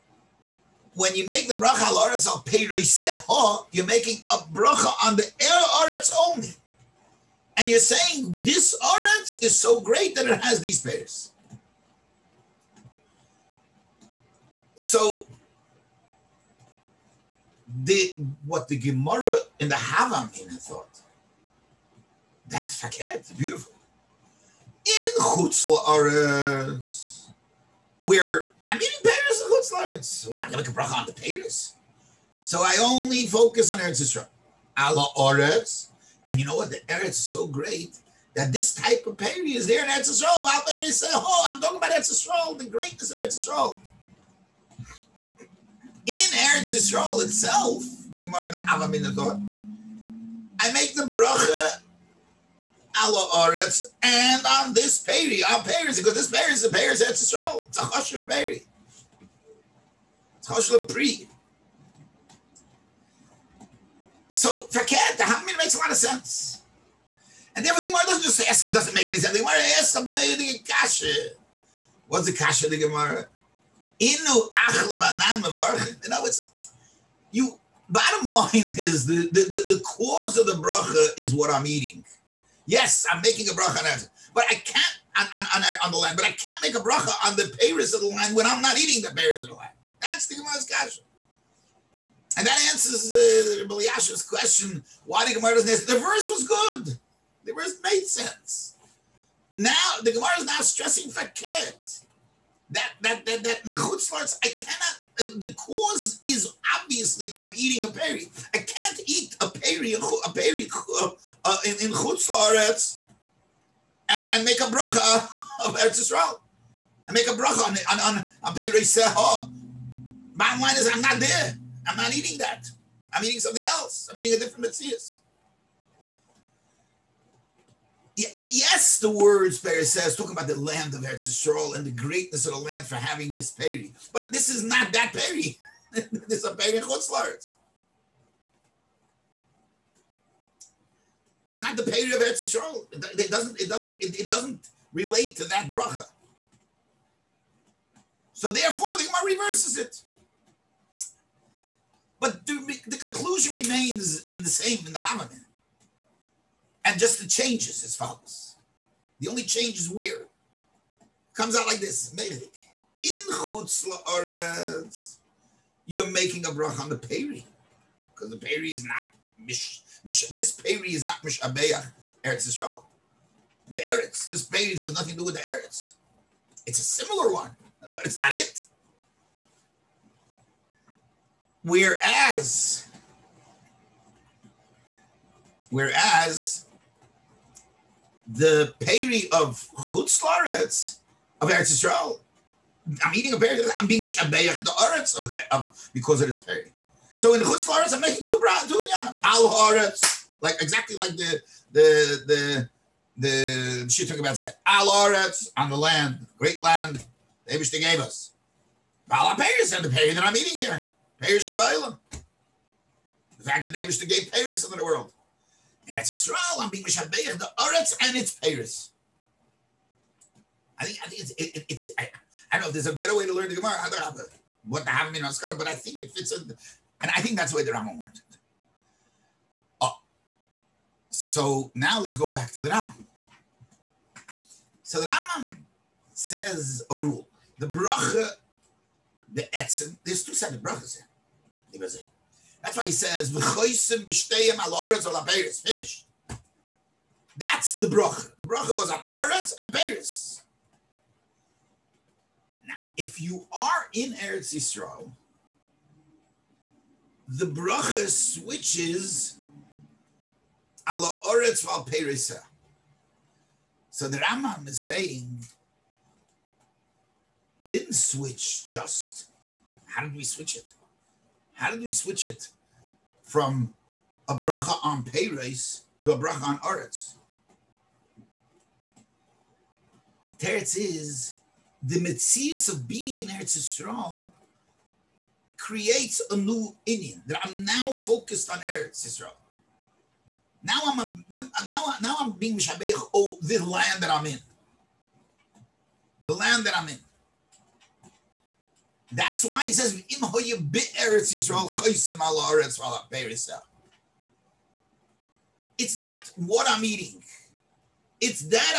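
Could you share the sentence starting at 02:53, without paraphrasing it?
The Eretz, this peri has nothing to do with the Eretz.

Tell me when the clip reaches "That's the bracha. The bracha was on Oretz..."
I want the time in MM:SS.
04:07.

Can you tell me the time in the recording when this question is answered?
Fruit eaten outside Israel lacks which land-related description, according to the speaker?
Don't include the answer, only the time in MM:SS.
02:50.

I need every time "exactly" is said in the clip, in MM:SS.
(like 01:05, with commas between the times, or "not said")
03:20.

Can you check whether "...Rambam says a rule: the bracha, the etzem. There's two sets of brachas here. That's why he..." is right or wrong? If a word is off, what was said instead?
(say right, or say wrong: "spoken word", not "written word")
right.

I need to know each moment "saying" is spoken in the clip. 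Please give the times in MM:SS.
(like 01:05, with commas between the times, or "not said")
00:07, 04:24.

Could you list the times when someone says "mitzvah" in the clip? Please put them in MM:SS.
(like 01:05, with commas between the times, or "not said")
02:04, 04:41.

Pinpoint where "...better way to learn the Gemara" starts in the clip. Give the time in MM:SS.
03:42.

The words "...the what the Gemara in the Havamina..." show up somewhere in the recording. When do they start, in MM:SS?
00:17.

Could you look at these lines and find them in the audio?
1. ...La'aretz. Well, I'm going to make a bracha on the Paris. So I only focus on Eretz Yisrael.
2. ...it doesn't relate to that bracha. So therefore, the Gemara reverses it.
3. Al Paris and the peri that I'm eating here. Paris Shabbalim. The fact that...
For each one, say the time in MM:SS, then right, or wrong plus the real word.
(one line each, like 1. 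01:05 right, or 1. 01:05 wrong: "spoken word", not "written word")
1. 00:29 right
2. 02:24 right
3. 03:29 right.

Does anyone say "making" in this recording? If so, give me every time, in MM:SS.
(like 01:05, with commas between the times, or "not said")
00:03, 01:23, 02:46, 03:17.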